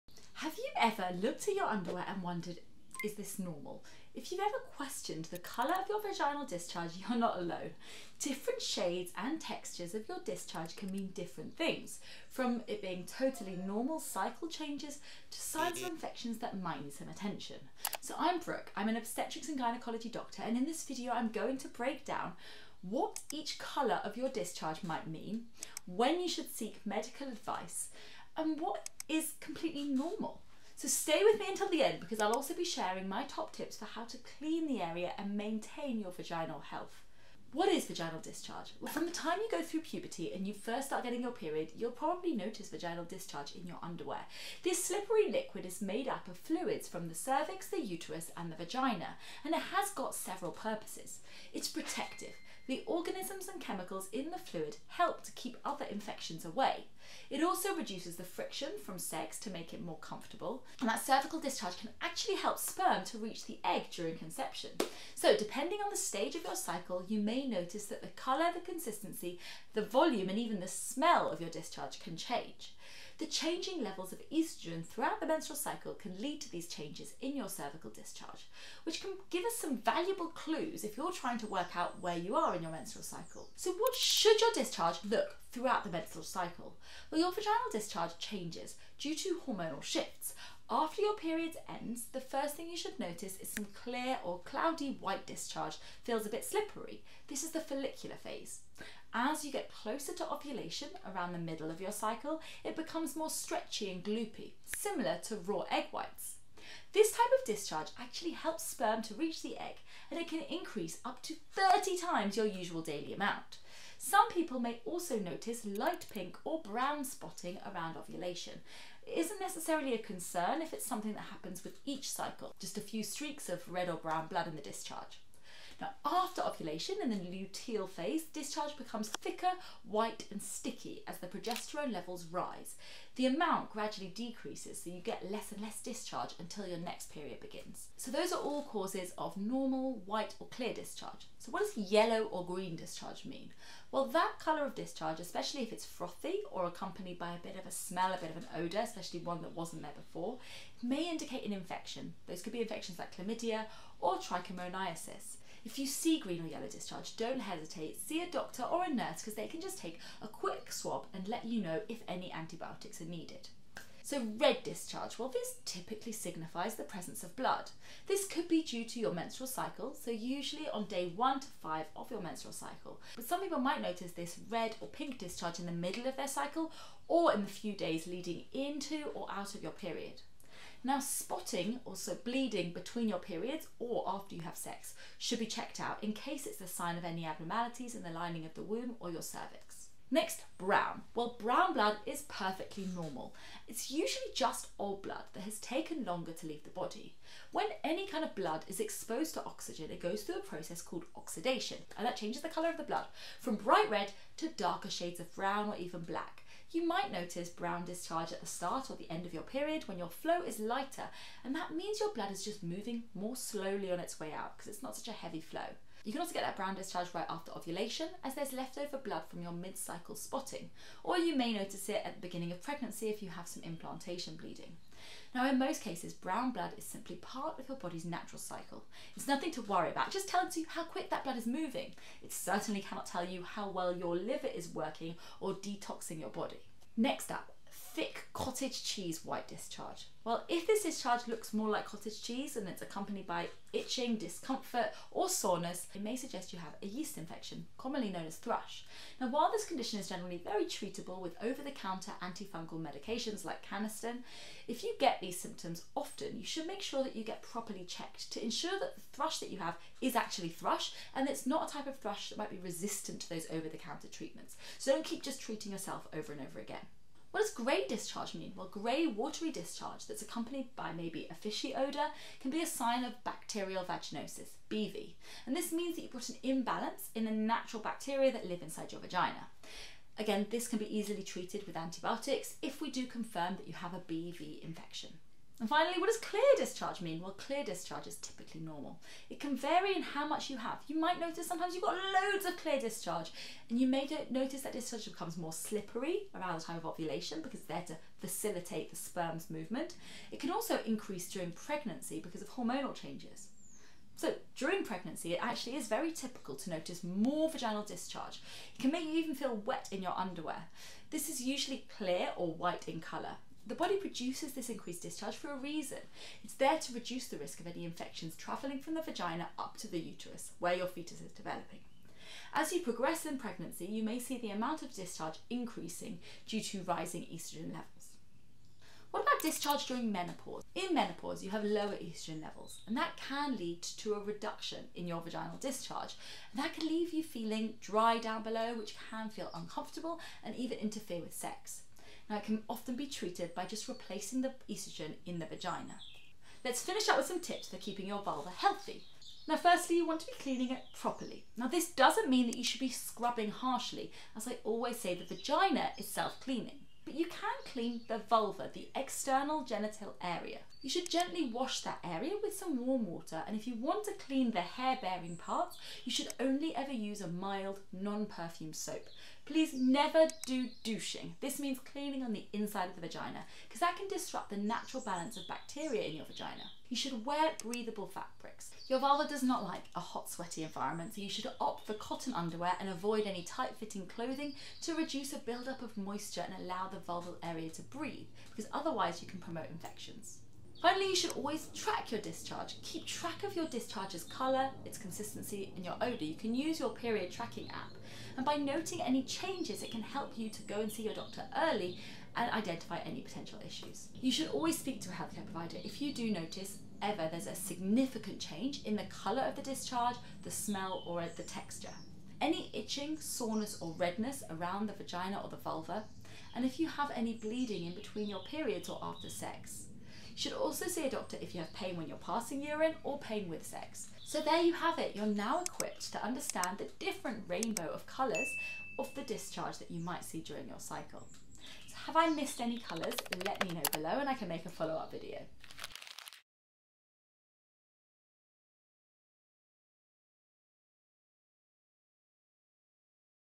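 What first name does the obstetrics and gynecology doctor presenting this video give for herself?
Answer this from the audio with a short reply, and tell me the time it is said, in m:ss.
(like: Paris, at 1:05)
Brooke, at 0:18.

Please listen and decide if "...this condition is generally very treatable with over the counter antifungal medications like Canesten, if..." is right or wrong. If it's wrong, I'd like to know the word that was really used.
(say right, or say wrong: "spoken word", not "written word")
right.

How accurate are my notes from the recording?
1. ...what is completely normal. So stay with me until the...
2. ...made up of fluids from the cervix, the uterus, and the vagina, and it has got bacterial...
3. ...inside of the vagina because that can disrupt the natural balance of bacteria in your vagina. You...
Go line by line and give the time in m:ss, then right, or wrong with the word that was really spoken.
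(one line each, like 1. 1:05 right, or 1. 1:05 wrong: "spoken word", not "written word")
1. 0:28 right
2. 0:45 wrong: "several", not "bacterial"
3. 6:12 right.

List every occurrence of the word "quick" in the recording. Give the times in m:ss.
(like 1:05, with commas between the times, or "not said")
2:40, 3:50.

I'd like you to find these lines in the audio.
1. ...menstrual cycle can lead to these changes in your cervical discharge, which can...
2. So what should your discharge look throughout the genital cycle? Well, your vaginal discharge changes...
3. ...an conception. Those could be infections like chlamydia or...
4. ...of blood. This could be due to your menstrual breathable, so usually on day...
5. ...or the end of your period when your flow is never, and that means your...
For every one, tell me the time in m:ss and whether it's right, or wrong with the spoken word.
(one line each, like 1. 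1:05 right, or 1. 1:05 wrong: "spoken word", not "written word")
1. 1:15 right
2. 1:23 wrong: "menstrual", not "genital"
3. 2:31 wrong: "infection", not "conception"
4. 2:47 wrong: "cycle", not "breathable"
5. 3:28 wrong: "lighter", not "never".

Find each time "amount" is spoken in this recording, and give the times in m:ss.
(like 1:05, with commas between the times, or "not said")
1:53, 2:13, 5:24.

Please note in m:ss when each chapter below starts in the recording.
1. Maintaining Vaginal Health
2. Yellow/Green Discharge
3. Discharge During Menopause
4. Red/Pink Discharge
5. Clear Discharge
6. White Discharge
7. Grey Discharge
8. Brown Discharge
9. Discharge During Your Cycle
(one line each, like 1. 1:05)
1. 5:46
2. 2:23
3. 5:29
4. 2:44
5. 4:46
6. 3:57
7. 4:27
8. 3:10
9. 1:22.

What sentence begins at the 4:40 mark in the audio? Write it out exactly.
Again, this can be easily treated with antibiotics if we do confirm that you have a BV infection.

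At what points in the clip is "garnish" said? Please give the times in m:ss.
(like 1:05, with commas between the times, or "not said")
not said.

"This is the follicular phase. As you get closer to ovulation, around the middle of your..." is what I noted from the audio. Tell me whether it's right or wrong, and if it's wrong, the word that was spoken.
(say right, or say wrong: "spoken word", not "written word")
right.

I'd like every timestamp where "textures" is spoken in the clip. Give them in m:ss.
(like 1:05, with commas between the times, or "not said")
0:09, 6:51.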